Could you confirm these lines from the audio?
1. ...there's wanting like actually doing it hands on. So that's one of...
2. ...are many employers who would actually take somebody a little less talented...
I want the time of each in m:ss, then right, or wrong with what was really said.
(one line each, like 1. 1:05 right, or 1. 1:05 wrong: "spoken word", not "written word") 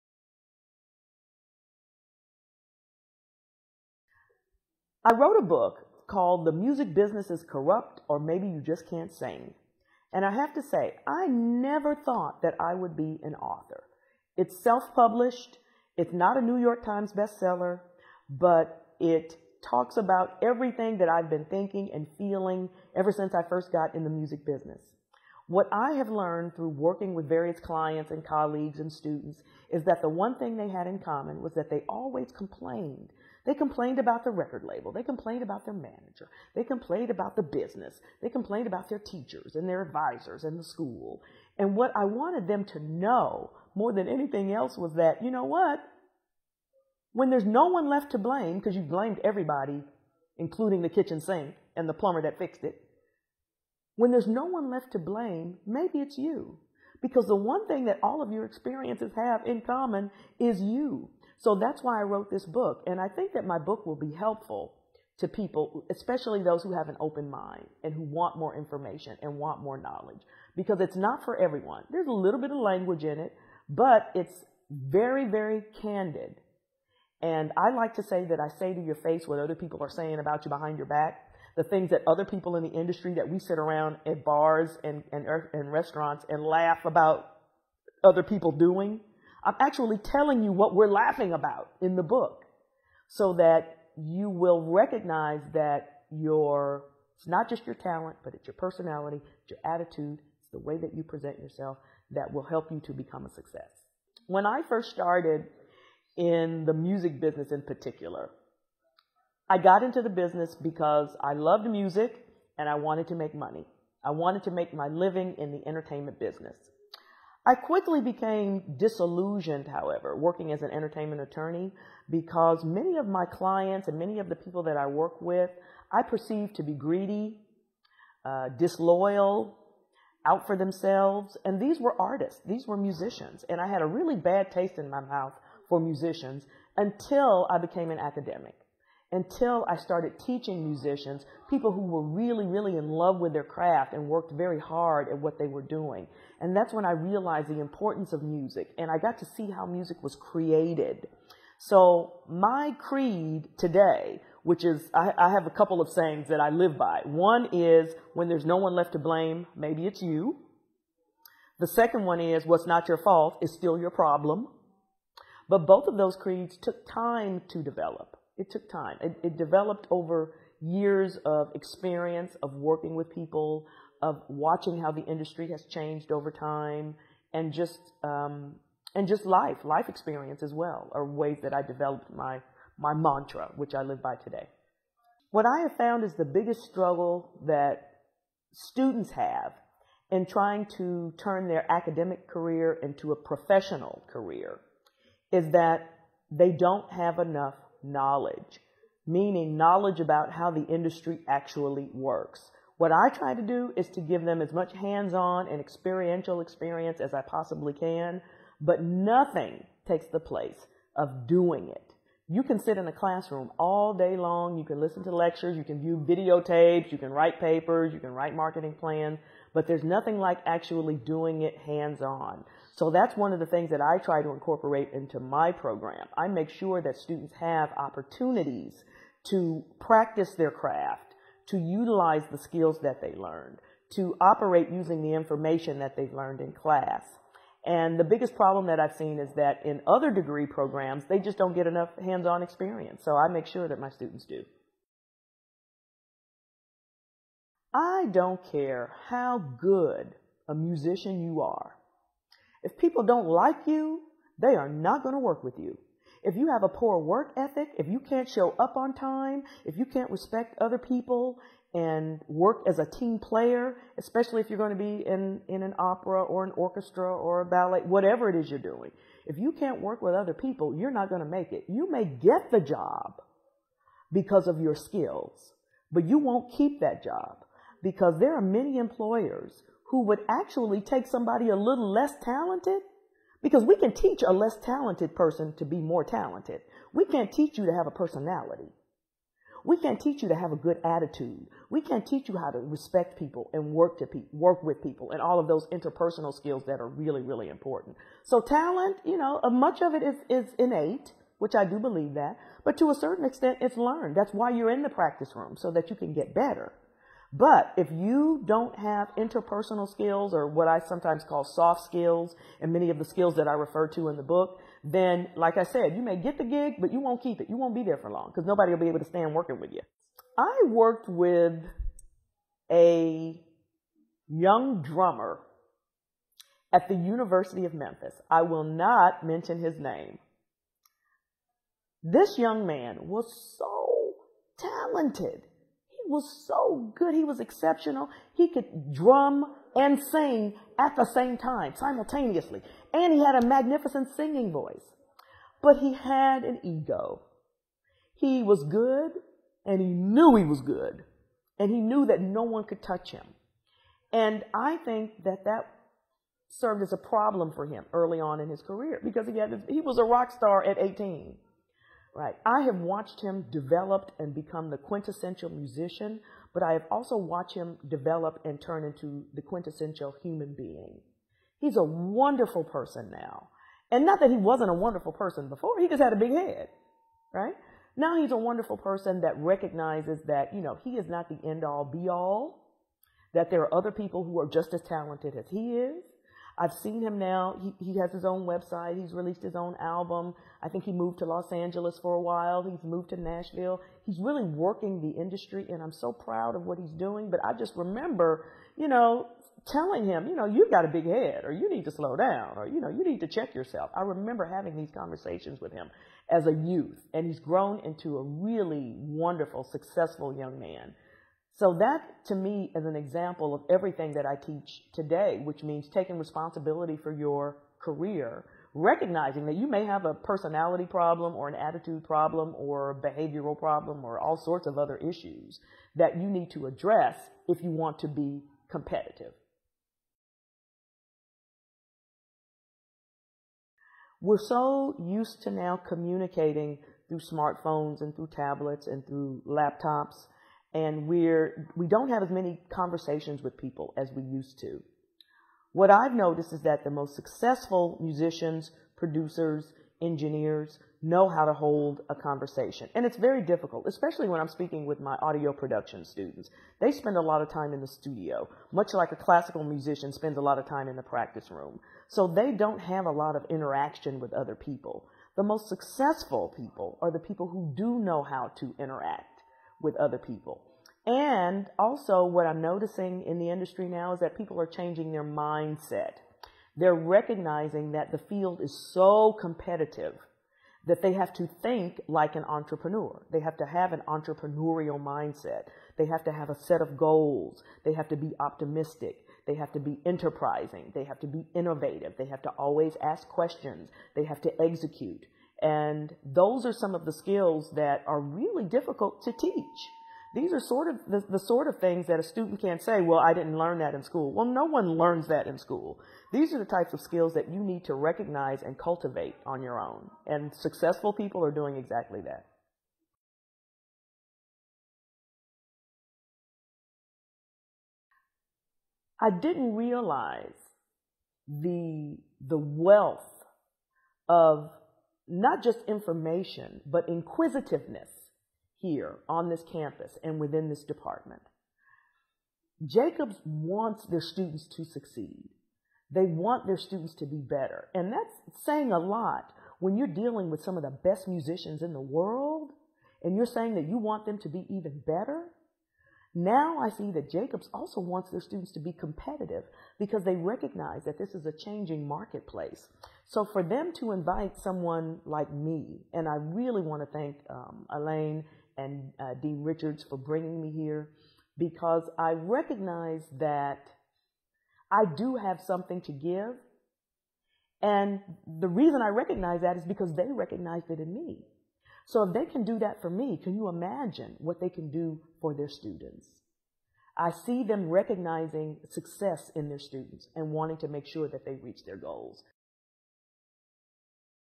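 1. 3:39 wrong: "nothing", not "wanting"
2. 4:38 right.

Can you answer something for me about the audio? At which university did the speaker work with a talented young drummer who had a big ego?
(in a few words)
University of Memphis.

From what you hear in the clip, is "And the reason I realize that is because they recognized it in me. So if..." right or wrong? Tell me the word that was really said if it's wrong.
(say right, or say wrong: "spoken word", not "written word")
wrong: "recognize", not "realize".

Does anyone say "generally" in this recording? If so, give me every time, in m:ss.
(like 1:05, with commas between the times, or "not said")
not said.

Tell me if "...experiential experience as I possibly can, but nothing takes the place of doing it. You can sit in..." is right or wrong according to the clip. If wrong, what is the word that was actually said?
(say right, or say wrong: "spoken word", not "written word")
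right.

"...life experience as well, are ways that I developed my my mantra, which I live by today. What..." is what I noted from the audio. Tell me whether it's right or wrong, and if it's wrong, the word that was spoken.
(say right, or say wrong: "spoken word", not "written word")
right.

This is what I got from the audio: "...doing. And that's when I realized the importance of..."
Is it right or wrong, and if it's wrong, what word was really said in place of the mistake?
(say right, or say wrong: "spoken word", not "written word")
right.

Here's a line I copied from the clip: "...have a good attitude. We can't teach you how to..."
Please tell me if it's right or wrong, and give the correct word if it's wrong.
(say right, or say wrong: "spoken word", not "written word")
right.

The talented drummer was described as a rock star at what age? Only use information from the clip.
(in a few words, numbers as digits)
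18.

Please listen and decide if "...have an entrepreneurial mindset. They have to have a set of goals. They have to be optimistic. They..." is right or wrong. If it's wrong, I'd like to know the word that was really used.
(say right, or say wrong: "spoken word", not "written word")
right.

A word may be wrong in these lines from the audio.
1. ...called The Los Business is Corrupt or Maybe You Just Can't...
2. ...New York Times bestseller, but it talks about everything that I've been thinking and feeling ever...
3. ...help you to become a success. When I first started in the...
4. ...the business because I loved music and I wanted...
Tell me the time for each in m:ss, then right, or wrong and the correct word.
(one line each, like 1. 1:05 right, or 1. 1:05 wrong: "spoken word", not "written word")
1. 0:06 wrong: "Music", not "Los"
2. 0:16 right
3. 1:42 right
4. 1:50 right.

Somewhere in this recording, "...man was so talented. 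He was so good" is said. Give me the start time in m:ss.
5:32.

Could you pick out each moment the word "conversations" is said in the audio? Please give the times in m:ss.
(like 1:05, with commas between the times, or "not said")
6:44, 7:22, 7:32.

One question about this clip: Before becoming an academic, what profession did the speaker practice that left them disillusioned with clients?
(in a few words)
Entertainment attorney.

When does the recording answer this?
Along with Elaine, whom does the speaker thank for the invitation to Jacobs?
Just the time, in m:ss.
9:19.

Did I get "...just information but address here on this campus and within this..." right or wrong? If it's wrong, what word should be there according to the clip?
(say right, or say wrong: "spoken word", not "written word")
wrong: "inquisitiveness", not "address".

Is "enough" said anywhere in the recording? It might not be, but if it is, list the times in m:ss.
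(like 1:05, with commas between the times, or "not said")
3:17, 4:01.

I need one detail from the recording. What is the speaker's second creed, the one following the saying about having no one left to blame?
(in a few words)
What's not your fault is still your problem.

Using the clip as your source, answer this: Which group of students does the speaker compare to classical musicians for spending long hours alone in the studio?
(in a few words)
Audio production students.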